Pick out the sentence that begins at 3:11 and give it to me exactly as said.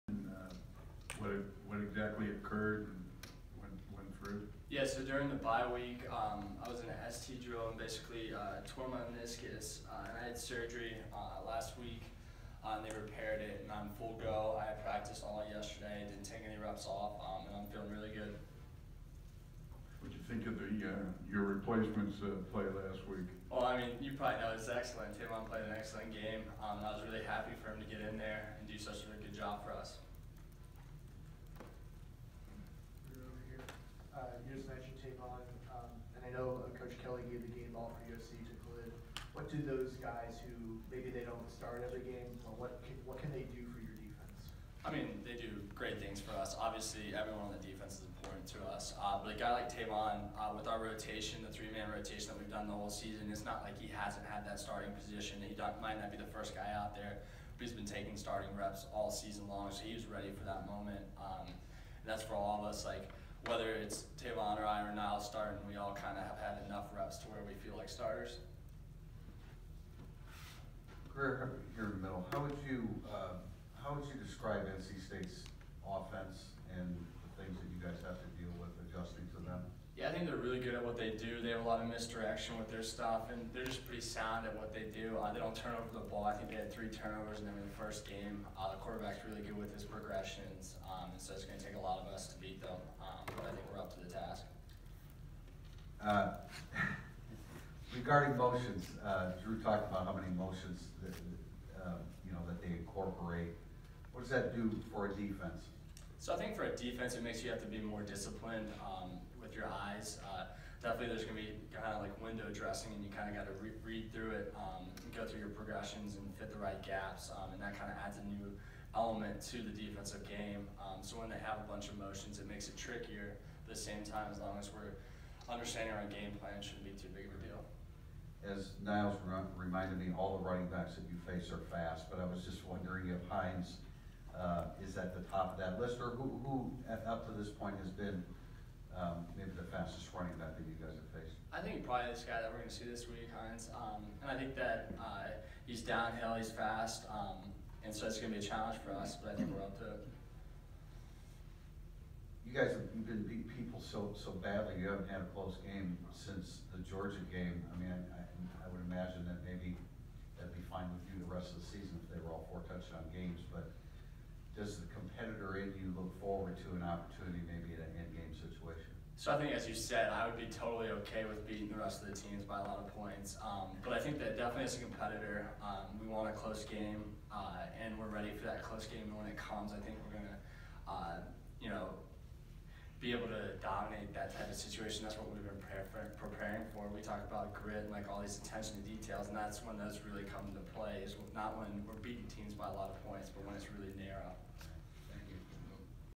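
Is not when we're beating teams by a lot of points, but when it's really narrow.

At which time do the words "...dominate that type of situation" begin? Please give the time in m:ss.
3:03.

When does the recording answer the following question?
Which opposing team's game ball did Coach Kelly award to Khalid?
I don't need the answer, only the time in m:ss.
0:38.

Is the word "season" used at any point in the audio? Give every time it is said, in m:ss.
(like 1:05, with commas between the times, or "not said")
0:52, 0:59, 2:41.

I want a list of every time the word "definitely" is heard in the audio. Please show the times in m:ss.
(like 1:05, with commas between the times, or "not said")
1:50, 2:54.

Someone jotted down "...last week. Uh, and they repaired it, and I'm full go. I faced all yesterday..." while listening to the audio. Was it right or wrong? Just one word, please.
wrong.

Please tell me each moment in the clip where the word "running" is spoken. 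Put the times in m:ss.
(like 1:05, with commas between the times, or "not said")
2:10, 2:20.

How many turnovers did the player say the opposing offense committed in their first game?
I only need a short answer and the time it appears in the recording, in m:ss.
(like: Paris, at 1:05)
3, at 1:26.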